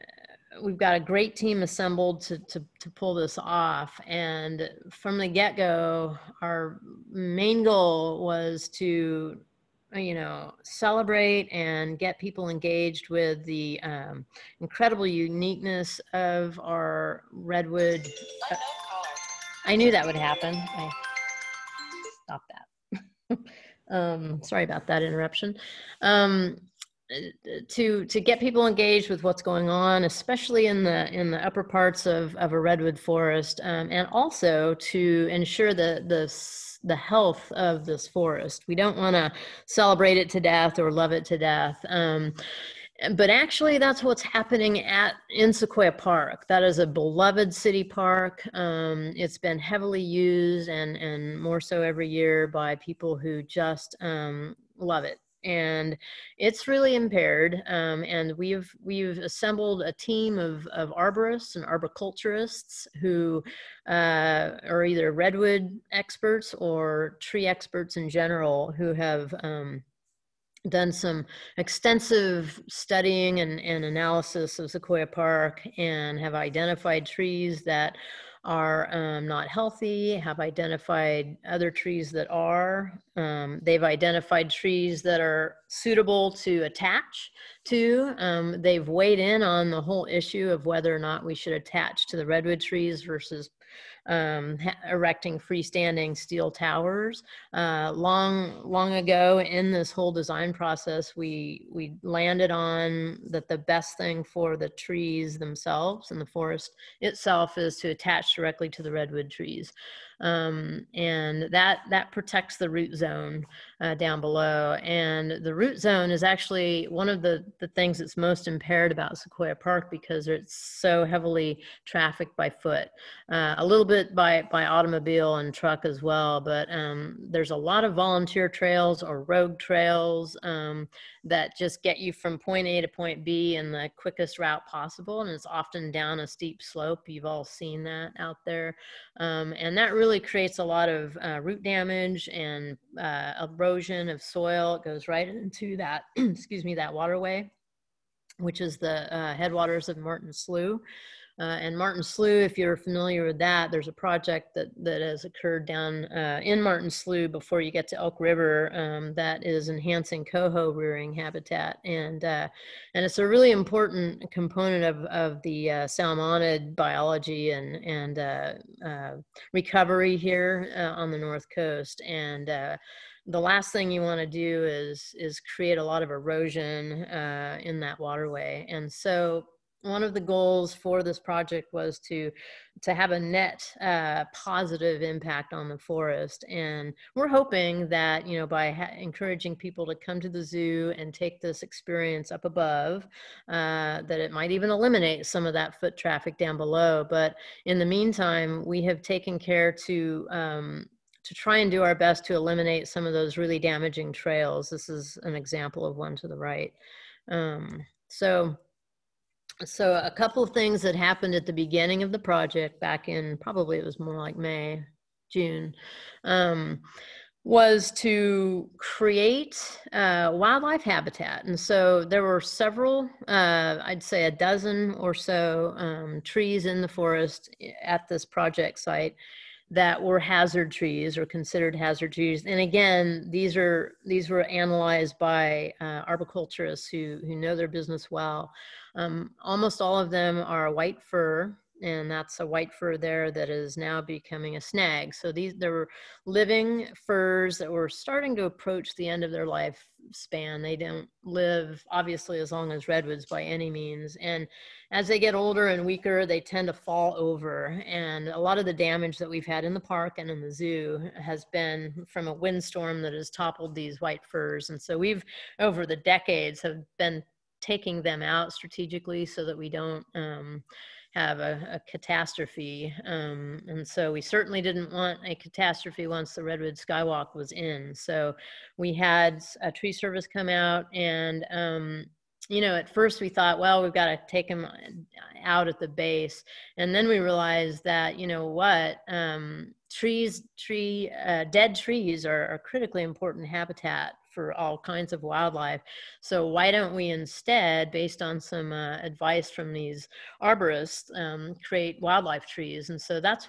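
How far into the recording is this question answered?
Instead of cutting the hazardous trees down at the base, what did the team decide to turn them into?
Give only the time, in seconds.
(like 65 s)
302 s.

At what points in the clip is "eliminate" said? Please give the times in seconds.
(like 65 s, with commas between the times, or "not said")
194 s, 202 s.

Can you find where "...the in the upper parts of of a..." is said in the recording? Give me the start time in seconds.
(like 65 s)
30 s.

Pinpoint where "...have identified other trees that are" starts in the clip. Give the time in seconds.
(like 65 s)
80 s.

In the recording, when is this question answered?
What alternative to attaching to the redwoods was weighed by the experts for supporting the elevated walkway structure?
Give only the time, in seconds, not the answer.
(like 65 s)
95 s.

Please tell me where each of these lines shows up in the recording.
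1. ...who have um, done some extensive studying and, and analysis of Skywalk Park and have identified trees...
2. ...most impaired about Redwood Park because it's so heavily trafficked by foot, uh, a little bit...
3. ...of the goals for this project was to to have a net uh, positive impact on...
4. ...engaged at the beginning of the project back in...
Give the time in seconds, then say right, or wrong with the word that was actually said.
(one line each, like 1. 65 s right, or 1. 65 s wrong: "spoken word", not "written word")
1. 68 s wrong: "Sequoia", not "Skywalk"
2. 118 s wrong: "Sequoia", not "Redwood"
3. 180 s right
4. 210 s wrong: "happened", not "engaged".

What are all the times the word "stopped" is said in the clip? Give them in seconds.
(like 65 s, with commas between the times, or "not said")
22 s.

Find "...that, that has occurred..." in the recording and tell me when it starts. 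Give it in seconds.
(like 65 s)
154 s.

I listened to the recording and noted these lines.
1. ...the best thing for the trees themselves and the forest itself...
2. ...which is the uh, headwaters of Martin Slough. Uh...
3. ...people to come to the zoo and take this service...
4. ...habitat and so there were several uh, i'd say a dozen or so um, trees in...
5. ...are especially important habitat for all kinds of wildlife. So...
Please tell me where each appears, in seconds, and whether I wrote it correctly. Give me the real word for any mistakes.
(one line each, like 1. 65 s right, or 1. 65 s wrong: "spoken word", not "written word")
1. 103 s right
2. 148 s right
3. 189 s wrong: "experience", not "service"
4. 220 s right
5. 292 s wrong: "critically", not "especially".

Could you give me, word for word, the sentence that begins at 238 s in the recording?
Um, almost all of them are white fir, and that's a white fir there that is now becoming a snag.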